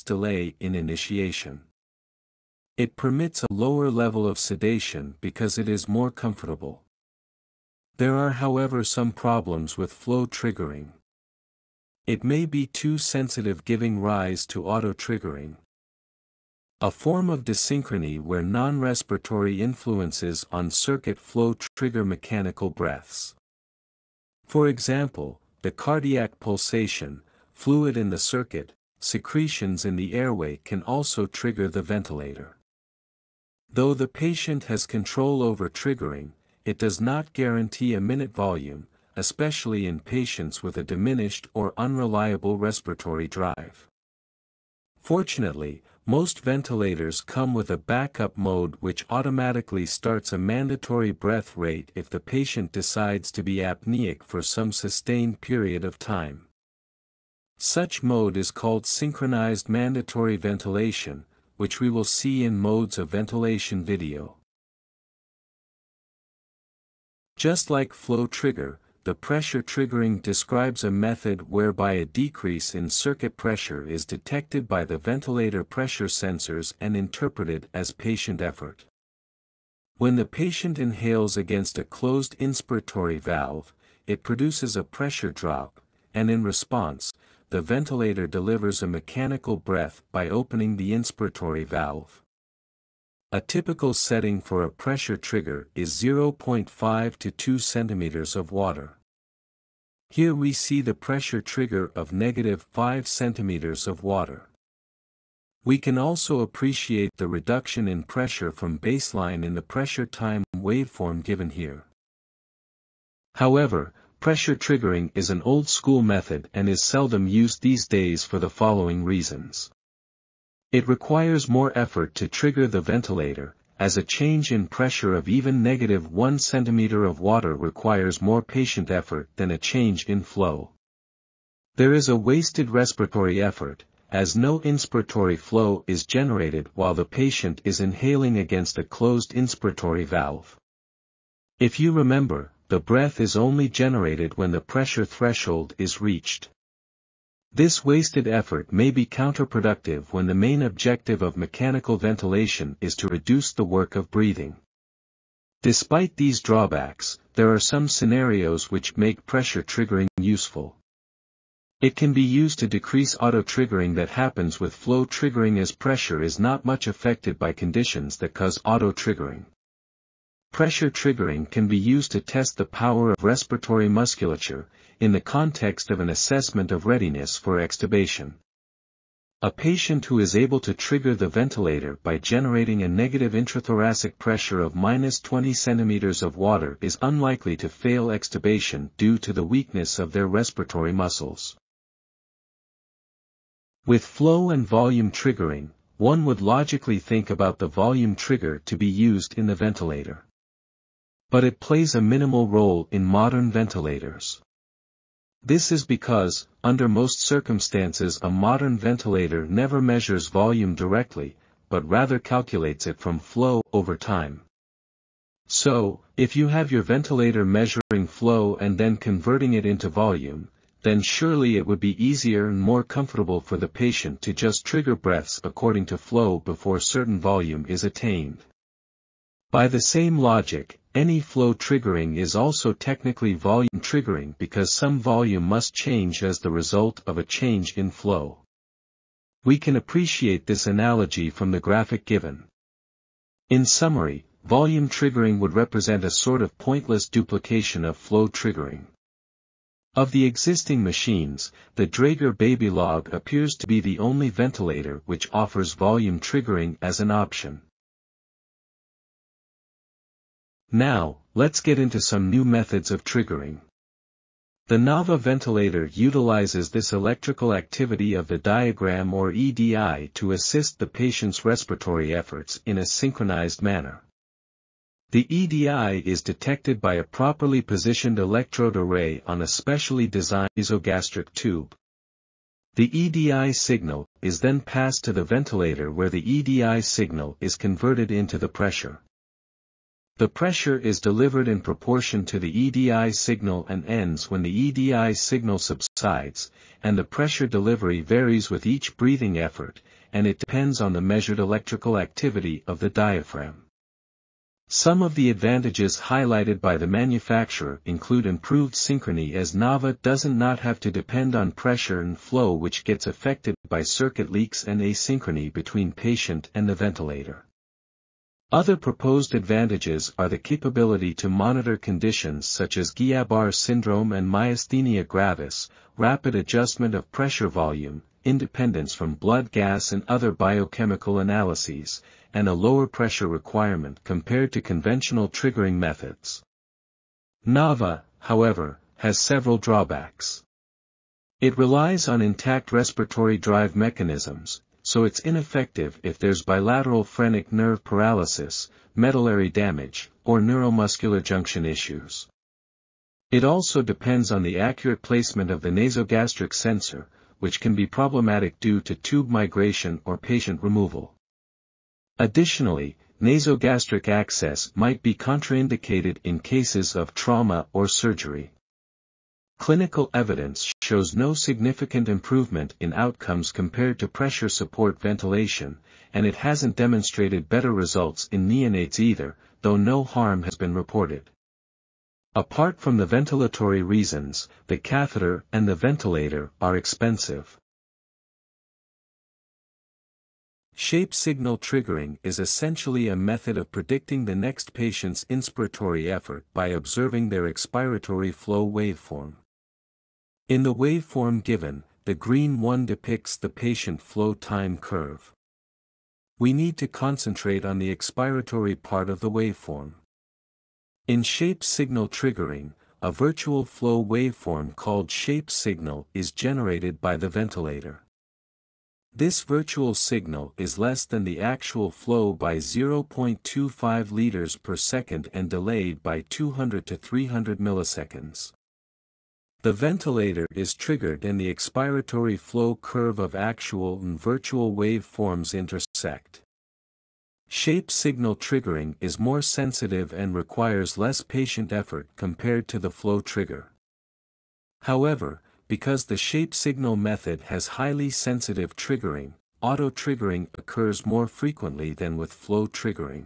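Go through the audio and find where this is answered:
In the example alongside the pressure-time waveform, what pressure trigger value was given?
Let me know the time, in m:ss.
1:42.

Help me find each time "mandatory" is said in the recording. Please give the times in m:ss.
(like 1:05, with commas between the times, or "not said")
0:50, 0:59.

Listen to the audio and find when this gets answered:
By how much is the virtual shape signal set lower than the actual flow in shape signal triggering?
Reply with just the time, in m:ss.
7:02.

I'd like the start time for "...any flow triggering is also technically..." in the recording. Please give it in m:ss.
3:50.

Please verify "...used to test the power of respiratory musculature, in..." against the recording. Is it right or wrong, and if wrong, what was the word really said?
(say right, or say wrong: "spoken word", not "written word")
right.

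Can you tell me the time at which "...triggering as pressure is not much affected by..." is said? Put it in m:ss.
2:45.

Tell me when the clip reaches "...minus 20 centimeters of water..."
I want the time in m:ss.
3:04.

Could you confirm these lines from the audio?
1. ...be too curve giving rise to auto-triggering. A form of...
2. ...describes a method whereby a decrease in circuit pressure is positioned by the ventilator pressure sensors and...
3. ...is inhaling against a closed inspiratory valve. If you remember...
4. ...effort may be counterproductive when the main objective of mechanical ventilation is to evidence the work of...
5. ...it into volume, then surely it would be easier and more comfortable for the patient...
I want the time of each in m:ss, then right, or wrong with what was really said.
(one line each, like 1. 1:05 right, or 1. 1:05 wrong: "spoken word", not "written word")
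1. 0:12 wrong: "sensitive", not "curve"
2. 1:10 wrong: "detected", not "positioned"
3. 2:17 right
4. 2:28 wrong: "reduce", not "evidence"
5. 3:39 right.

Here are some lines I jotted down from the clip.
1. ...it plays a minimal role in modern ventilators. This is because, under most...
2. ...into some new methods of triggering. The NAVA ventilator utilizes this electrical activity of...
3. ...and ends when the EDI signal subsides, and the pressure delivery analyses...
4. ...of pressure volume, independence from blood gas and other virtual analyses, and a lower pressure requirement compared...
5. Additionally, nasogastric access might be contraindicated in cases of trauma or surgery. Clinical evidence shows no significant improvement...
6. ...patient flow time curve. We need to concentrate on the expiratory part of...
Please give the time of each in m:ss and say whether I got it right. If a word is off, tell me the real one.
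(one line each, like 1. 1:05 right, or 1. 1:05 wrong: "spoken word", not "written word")
1. 3:21 right
2. 4:21 right
3. 4:53 wrong: "varies", not "analyses"
4. 5:26 wrong: "biochemical", not "virtual"
5. 6:02 right
6. 6:43 right.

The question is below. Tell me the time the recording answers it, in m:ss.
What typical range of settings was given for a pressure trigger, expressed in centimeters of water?
1:35.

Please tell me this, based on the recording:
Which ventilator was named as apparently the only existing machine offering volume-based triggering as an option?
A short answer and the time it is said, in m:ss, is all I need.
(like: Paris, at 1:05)
Draeger Babylog, at 4:11.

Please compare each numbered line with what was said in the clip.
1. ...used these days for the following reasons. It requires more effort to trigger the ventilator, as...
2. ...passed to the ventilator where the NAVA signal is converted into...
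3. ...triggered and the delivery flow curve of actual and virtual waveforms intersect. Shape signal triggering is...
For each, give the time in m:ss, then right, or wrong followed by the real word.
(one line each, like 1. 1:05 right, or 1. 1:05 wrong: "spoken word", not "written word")
1. 1:57 right
2. 4:44 wrong: "EDI", not "NAVA"
3. 7:10 wrong: "expiratory", not "delivery".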